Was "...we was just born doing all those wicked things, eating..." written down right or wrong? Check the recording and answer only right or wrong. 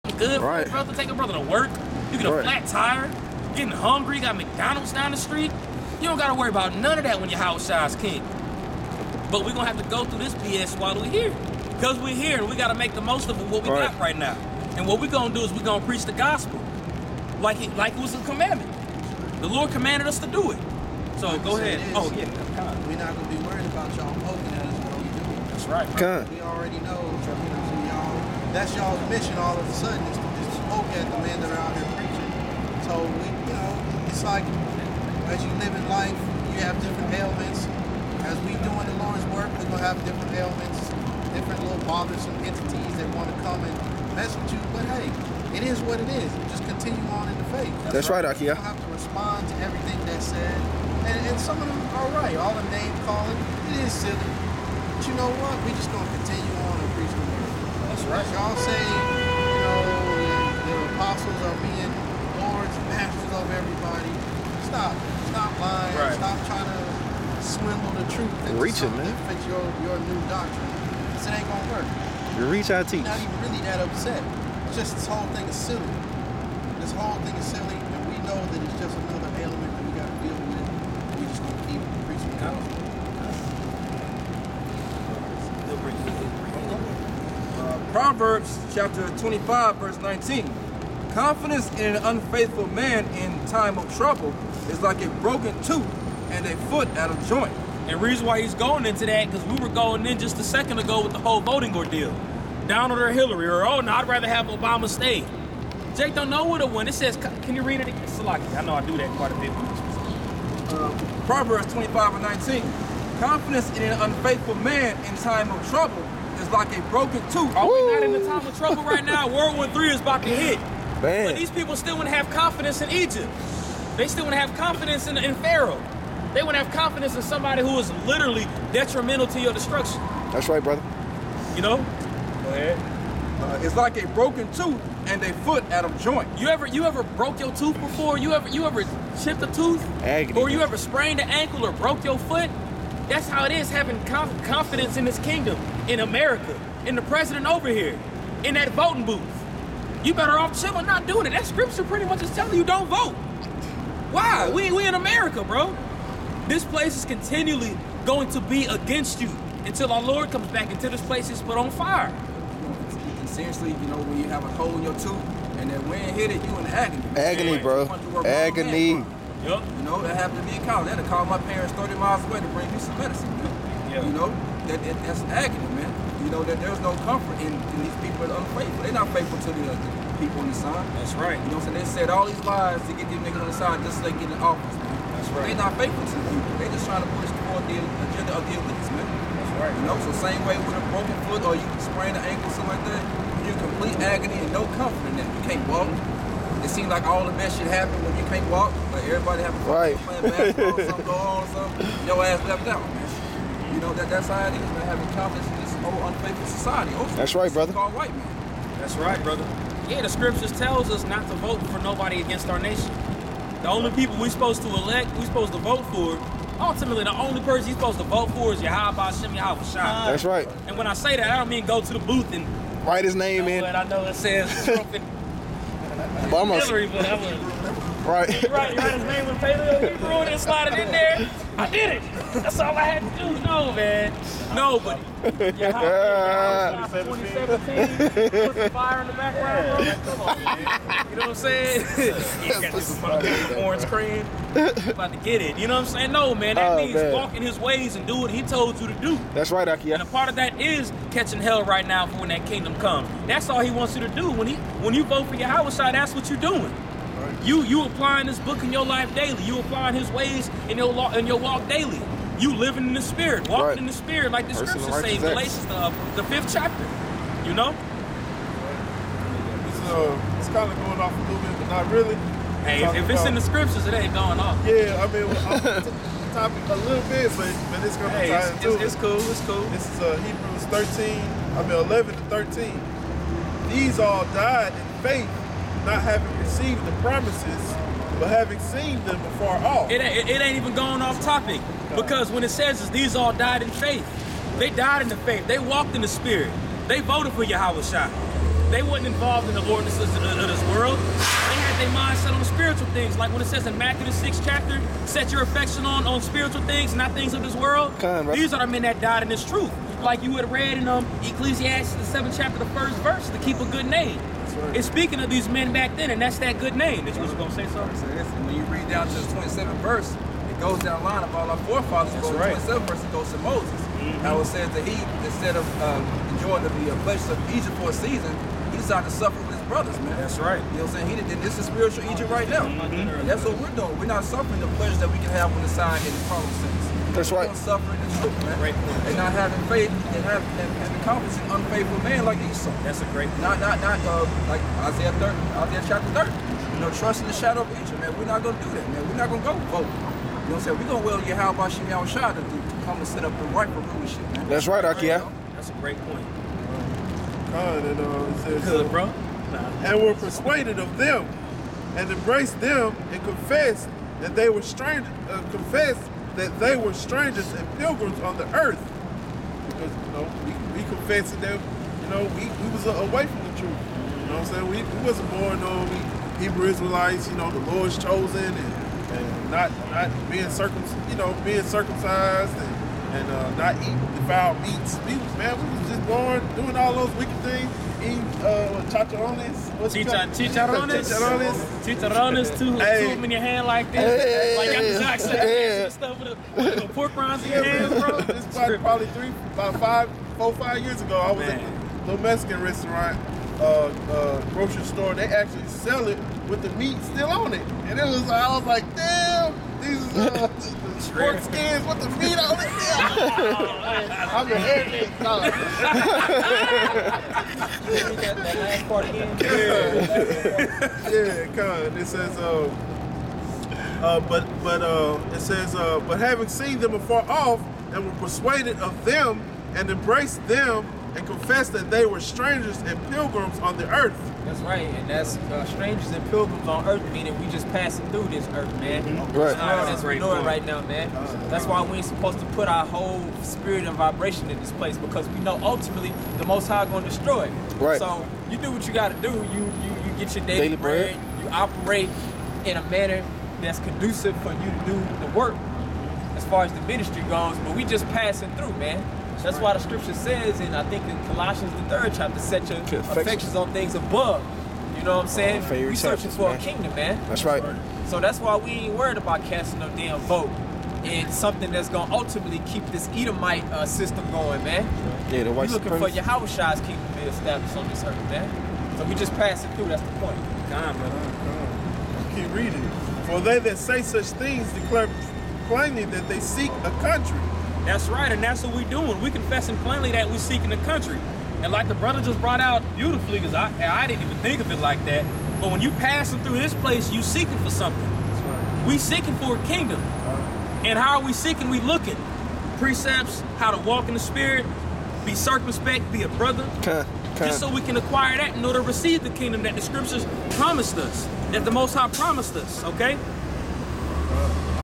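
right.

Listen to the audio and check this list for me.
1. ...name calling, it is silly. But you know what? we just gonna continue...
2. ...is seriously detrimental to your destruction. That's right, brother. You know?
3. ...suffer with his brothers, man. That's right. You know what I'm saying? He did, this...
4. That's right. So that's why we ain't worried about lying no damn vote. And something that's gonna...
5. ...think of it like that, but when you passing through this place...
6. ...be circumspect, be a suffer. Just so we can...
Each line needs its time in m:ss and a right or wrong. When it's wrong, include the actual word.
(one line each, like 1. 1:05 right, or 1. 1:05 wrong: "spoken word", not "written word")
1. 0:52 right
2. 2:07 wrong: "literally", not "seriously"
3. 5:29 right
4. 7:47 wrong: "casting", not "lying"
5. 8:14 right
6. 8:25 wrong: "brother", not "suffer".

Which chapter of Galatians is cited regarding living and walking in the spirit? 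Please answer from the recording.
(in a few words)
Fifth chapter.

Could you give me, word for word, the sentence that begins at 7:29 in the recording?
You you, you get your daily, daily bread.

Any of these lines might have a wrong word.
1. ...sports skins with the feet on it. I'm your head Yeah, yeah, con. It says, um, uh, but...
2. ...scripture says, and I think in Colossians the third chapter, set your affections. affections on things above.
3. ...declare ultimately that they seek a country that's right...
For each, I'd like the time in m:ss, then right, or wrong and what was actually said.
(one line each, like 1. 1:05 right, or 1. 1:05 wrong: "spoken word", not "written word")
1. 6:50 right
2. 7:39 right
3. 8:04 wrong: "plainly", not "ultimately".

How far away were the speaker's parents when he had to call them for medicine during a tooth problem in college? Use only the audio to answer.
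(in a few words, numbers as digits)
30 miles.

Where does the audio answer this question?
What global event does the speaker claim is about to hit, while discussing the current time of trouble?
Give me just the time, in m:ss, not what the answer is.
1:59.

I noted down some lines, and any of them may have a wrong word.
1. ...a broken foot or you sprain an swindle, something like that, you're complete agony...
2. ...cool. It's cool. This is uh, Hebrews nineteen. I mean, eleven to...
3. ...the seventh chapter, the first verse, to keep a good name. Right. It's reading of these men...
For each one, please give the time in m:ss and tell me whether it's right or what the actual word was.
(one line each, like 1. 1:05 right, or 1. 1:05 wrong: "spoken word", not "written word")
1. 3:10 wrong: "ankle", not "swindle"
2. 4:38 wrong: "thirteen", not "nineteen"
3. 5:11 wrong: "speaking", not "reading".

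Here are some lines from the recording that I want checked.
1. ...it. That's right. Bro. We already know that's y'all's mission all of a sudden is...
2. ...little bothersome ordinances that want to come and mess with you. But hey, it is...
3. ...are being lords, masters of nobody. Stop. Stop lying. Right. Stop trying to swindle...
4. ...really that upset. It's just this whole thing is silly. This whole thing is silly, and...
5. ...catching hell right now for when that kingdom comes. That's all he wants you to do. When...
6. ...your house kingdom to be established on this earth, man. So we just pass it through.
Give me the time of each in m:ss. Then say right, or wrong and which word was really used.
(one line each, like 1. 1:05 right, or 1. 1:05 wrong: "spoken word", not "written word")
1. 0:25 right
2. 0:41 wrong: "entities", not "ordinances"
3. 1:01 wrong: "everybody", not "nobody"
4. 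1:13 right
5. 4:11 right
6. 7:56 right.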